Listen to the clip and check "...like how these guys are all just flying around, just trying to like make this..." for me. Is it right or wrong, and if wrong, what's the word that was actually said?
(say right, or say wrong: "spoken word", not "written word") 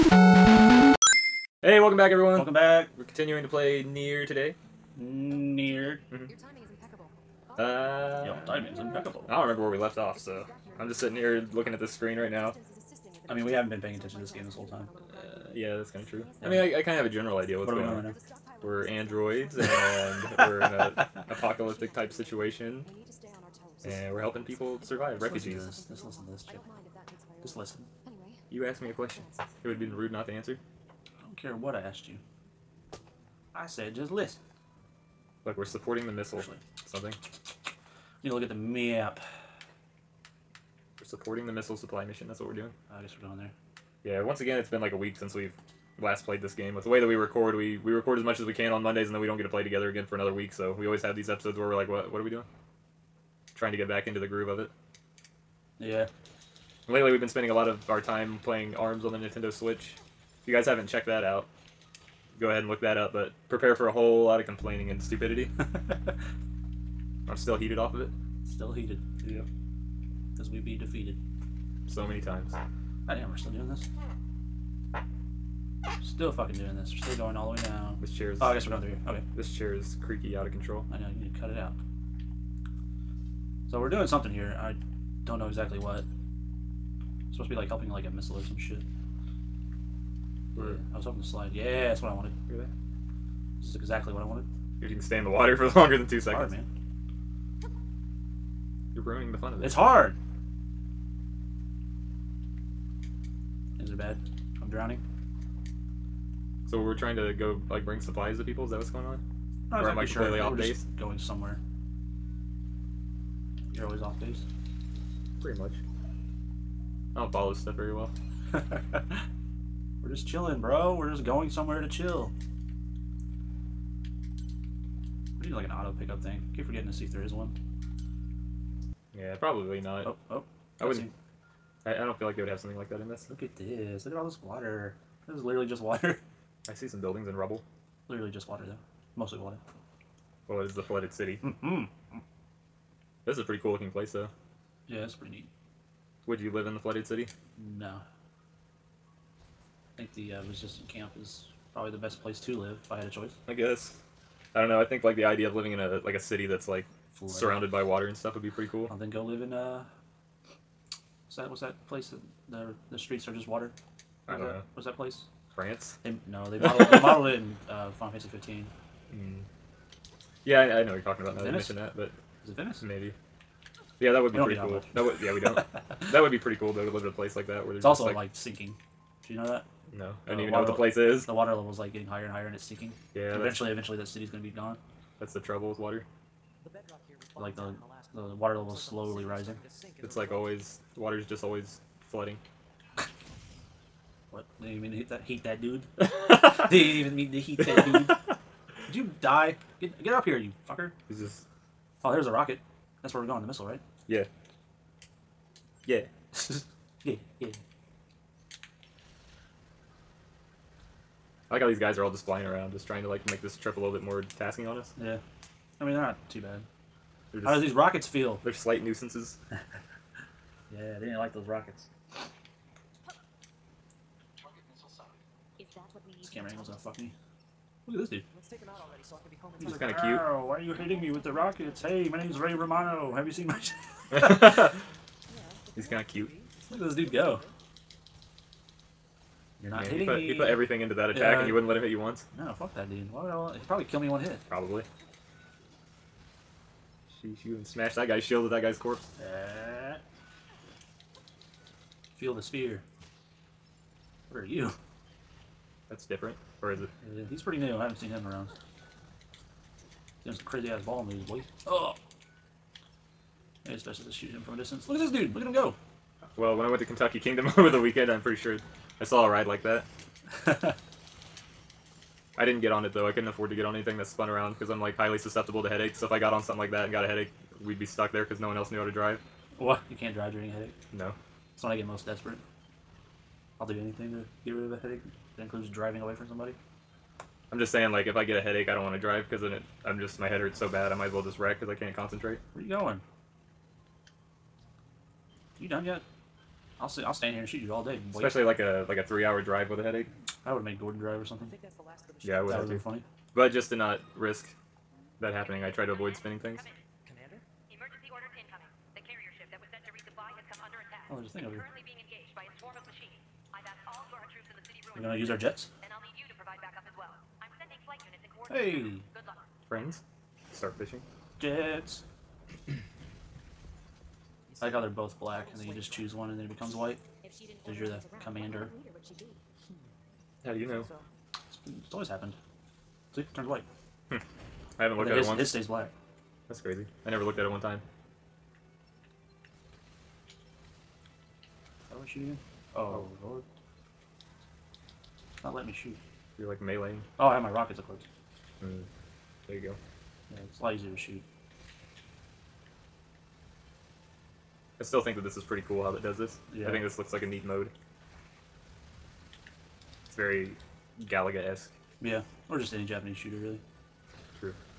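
right.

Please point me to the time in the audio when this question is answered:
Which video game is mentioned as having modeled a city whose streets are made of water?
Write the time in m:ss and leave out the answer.
2:47.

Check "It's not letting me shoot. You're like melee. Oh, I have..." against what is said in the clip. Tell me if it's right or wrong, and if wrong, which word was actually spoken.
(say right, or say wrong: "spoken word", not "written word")
right.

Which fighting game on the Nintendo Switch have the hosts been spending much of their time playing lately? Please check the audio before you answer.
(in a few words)
ARMS.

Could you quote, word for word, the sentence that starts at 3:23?
That's where we're going, the missile, right?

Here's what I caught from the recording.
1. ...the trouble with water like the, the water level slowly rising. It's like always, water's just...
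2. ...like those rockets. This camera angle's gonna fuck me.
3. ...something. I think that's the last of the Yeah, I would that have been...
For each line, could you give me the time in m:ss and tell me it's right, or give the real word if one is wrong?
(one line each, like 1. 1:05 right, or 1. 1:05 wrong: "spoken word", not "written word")
1. 3:05 right
2. 3:41 right
3. 5:01 right.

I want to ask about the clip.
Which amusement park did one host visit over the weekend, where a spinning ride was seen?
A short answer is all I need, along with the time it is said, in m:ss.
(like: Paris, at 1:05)
Kentucky Kingdom, at 4:26.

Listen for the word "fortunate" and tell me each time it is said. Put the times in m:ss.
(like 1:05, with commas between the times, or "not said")
not said.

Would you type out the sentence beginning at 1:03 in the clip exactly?
But prepare for a whole lot of complaining and stupidity.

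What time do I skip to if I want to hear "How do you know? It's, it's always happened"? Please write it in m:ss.
5:30.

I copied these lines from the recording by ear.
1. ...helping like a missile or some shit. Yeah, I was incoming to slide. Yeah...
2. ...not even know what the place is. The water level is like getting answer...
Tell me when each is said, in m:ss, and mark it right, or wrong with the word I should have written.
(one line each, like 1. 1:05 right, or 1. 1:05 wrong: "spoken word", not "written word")
1. 1:27 wrong: "hoping", not "incoming"
2. 3:00 wrong: "higher", not "answer".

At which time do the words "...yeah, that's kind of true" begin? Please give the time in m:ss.
0:15.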